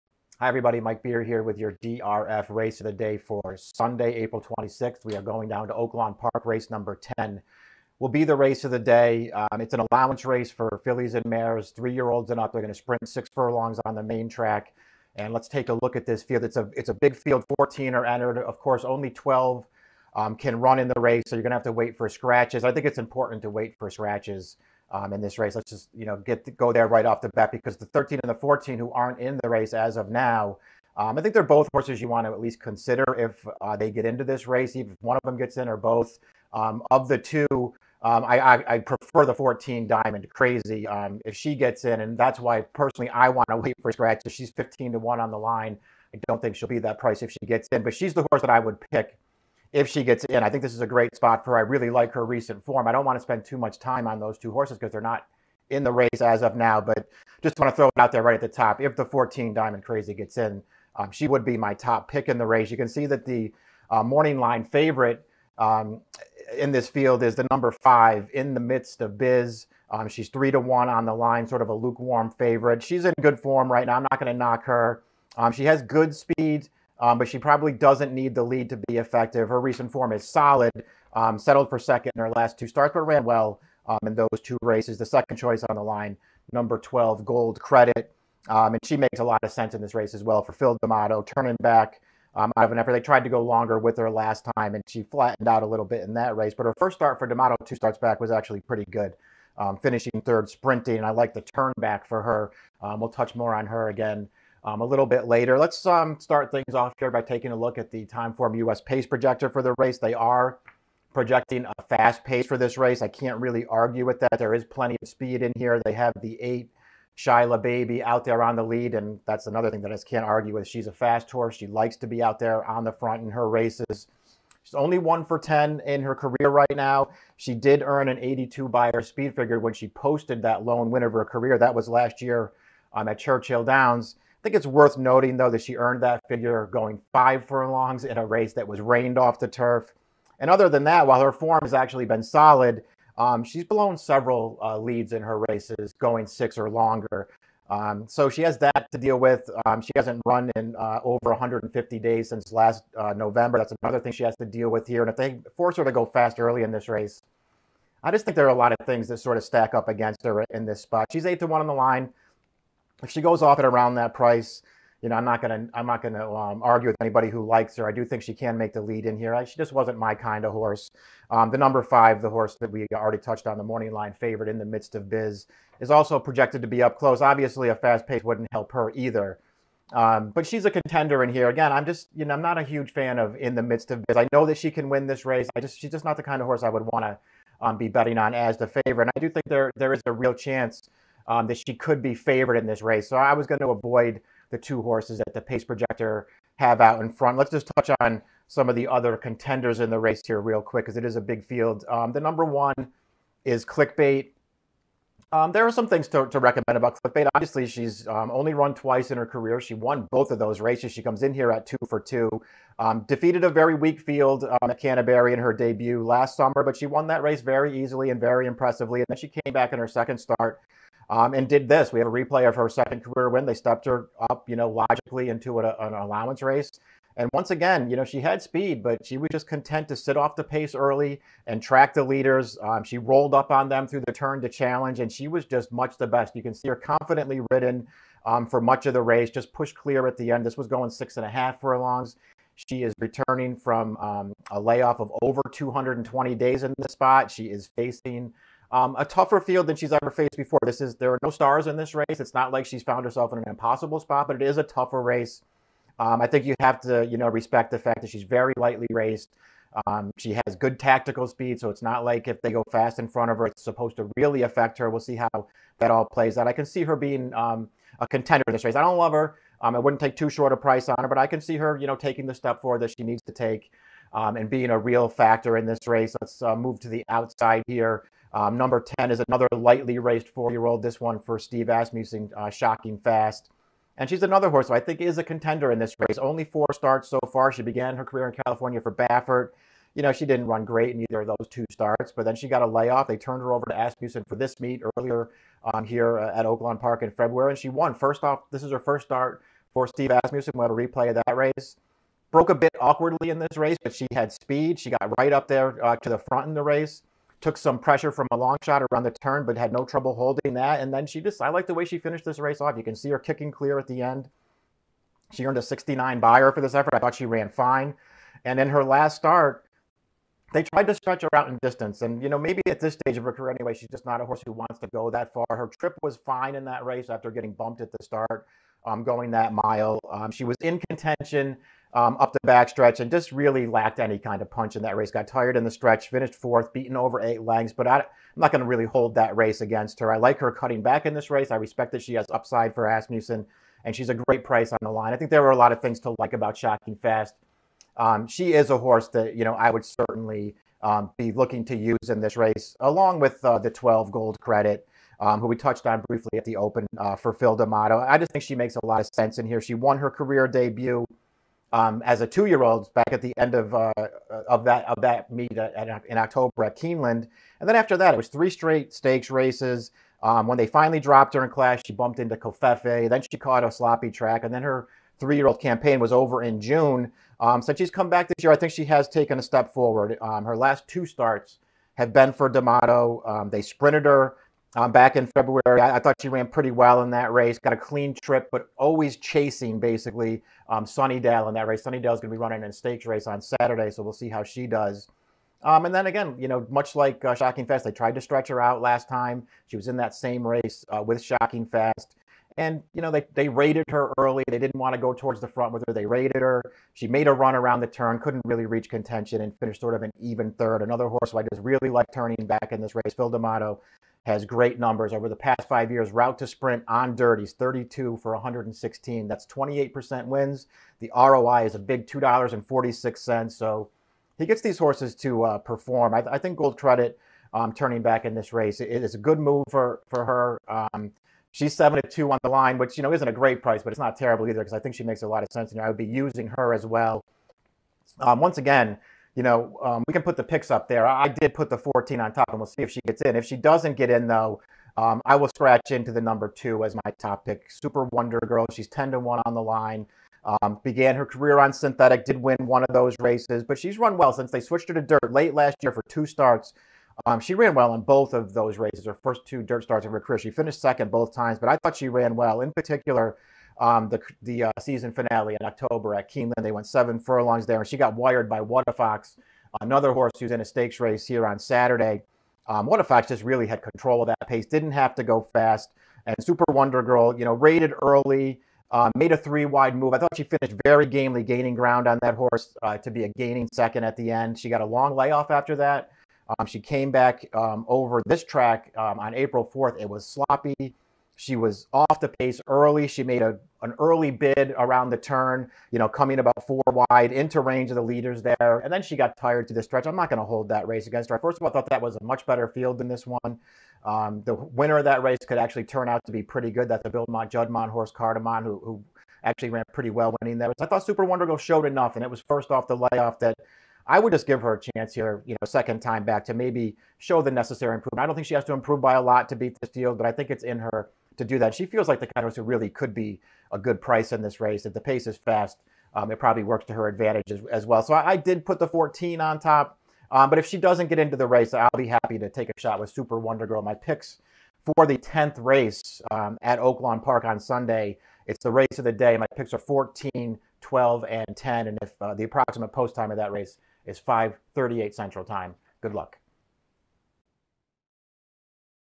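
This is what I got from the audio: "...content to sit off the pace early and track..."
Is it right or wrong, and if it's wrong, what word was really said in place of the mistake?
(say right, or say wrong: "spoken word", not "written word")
right.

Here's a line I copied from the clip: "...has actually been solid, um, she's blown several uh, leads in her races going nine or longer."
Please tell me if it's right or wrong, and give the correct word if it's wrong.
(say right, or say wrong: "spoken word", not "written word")
wrong: "six", not "nine".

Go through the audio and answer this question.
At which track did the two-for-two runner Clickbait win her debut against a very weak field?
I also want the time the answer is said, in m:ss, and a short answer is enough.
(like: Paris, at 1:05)
Canterbury, at 3:34.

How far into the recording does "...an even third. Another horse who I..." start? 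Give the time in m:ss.
6:50.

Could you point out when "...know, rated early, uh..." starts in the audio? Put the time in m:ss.
7:57.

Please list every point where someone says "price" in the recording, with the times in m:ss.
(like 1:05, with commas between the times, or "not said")
0:46, 2:44, 4:30, 5:44, 7:13, 8:44.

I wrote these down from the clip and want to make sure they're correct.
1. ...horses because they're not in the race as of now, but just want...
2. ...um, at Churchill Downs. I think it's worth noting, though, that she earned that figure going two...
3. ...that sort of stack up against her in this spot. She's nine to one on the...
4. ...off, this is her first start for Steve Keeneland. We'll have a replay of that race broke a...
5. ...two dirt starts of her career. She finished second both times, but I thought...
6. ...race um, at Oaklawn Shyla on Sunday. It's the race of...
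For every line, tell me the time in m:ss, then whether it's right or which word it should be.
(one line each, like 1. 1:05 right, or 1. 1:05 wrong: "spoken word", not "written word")
1. 0:54 right
2. 2:12 wrong: "five", not "two"
3. 2:39 wrong: "eight", not "nine"
4. 4:58 wrong: "Asmussen", not "Keeneland"
5. 7:39 right
6. 8:55 wrong: "Park", not "Shyla".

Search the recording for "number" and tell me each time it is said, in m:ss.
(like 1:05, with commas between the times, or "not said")
0:06, 1:07, 1:26, 2:51, 3:22, 4:38, 6:54, 7:26.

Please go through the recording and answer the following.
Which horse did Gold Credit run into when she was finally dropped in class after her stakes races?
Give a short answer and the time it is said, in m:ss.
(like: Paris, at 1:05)
Kofefe, at 6:12.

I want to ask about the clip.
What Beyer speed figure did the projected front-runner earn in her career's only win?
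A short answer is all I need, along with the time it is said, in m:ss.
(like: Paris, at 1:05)
82, at 2:08.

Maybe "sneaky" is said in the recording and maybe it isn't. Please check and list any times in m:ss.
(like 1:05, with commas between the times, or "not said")
not said.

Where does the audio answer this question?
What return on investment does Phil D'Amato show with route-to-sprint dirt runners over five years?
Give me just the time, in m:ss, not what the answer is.
7:02.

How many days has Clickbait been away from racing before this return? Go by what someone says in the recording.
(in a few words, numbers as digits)
over 220.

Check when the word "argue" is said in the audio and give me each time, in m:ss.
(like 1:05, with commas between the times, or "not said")
1:53, 2:00, 2:46.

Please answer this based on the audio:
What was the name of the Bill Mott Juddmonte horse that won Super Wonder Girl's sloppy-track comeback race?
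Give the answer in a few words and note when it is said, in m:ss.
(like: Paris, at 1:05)
Cardamon, at 8:28.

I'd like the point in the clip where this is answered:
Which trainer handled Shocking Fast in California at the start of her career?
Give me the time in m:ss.
4:48.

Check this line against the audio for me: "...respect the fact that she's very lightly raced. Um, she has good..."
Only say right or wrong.
right.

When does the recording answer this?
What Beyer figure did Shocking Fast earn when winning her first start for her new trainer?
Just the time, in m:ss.
5:15.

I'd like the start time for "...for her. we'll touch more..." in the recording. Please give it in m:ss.
1:42.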